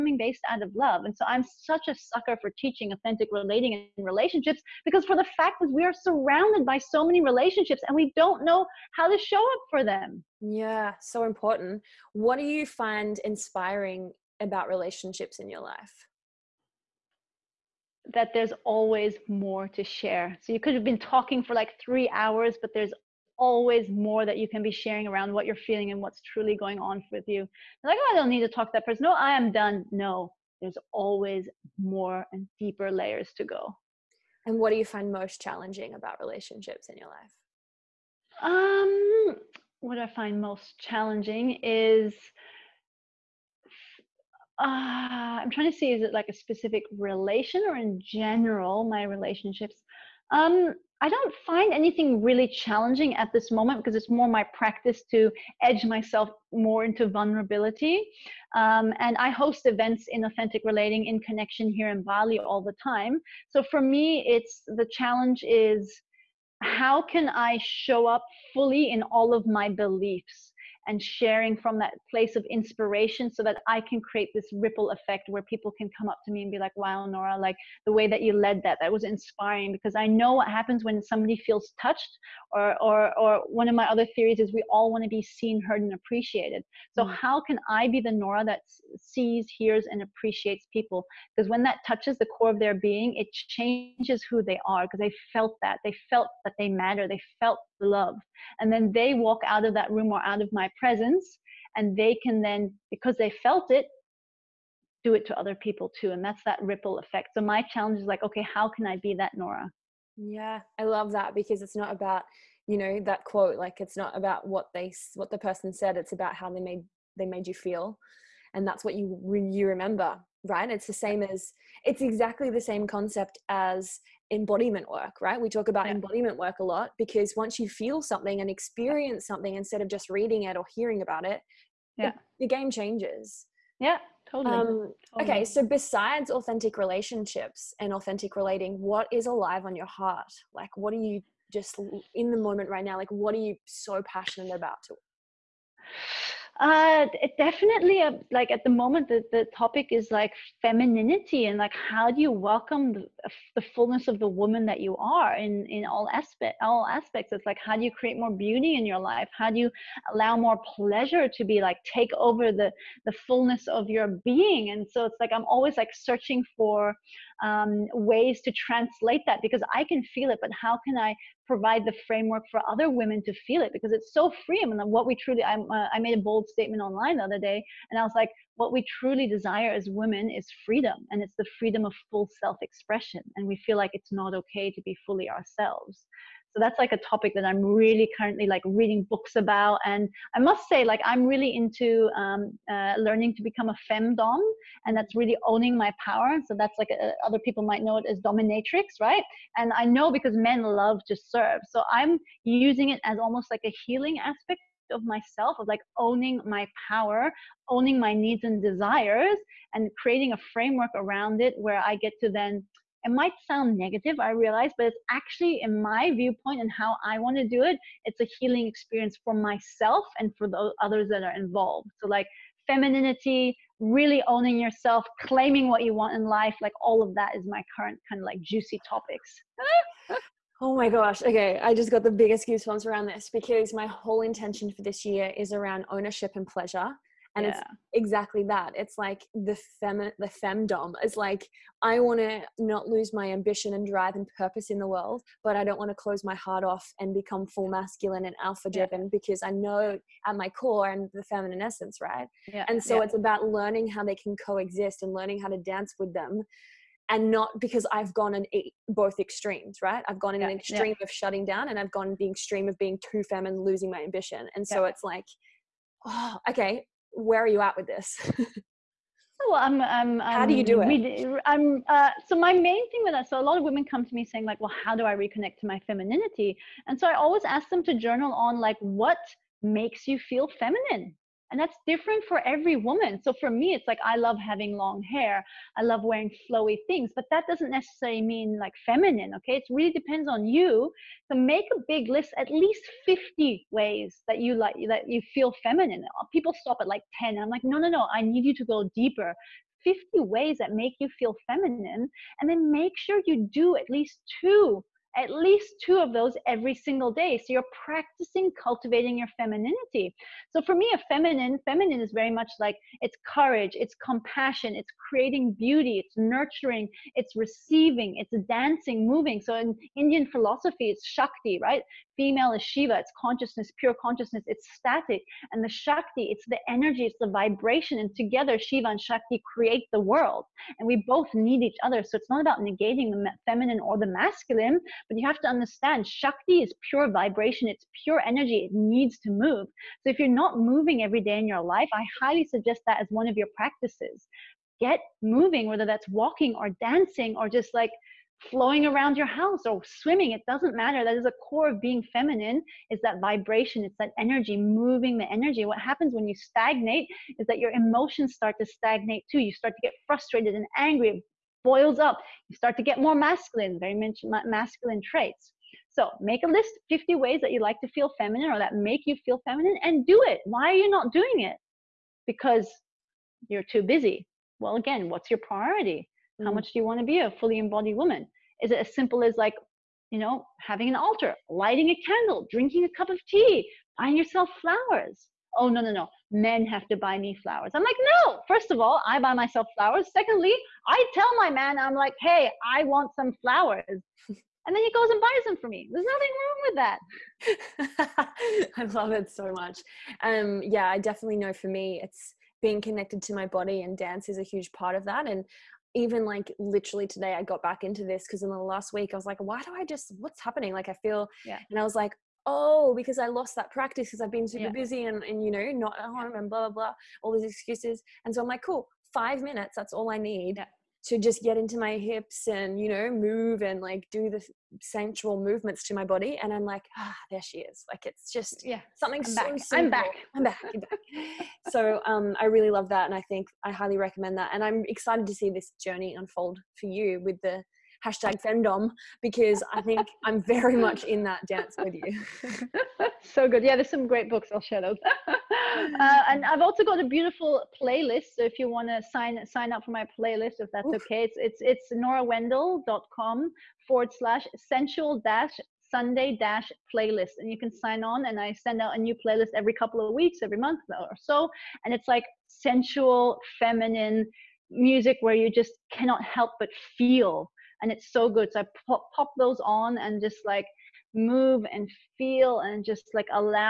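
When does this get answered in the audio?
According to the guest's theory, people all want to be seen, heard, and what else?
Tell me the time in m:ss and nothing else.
1:25.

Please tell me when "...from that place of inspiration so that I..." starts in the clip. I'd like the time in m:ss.
1:11.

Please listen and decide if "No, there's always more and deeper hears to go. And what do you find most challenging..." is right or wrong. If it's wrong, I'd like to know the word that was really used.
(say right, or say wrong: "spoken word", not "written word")
wrong: "layers", not "hears".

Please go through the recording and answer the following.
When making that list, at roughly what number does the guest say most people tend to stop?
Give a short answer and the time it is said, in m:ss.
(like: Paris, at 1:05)
10, at 4:57.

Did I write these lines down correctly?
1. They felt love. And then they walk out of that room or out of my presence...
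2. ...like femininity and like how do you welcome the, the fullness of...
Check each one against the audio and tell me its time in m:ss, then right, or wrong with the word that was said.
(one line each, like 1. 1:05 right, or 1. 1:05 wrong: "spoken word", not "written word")
1. 1:37 right
2. 2:30 right.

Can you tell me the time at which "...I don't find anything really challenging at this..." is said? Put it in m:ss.
0:51.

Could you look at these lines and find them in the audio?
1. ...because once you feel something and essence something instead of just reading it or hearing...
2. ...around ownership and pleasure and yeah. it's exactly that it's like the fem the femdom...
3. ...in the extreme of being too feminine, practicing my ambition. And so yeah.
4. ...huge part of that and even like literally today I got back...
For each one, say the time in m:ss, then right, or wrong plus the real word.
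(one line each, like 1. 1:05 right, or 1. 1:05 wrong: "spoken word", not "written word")
1. 2:06 wrong: "experience", not "essence"
2. 3:55 right
3. 4:22 wrong: "losing", not "practicing"
4. 6:44 right.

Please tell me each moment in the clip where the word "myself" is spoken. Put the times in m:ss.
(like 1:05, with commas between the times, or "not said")
0:55, 3:25, 3:39, 6:29.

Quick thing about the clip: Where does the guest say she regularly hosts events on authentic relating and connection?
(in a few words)
Bali.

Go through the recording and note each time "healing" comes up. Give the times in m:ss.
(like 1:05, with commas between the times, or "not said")
3:23, 3:38.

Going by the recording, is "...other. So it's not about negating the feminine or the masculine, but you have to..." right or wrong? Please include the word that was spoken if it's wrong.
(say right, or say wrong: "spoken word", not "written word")
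right.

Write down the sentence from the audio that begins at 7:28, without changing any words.
So if you want to sign sign up for my playlist, if that's Oof.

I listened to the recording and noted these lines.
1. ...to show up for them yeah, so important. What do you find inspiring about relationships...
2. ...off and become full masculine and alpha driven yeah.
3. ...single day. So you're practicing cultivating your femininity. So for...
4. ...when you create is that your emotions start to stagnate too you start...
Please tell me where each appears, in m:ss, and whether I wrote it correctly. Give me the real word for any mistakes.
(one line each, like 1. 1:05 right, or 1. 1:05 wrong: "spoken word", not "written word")
1. 0:09 right
2. 4:06 right
3. 5:06 right
4. 5:56 wrong: "stagnate", not "create".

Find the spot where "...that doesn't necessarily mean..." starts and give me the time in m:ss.
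4:47.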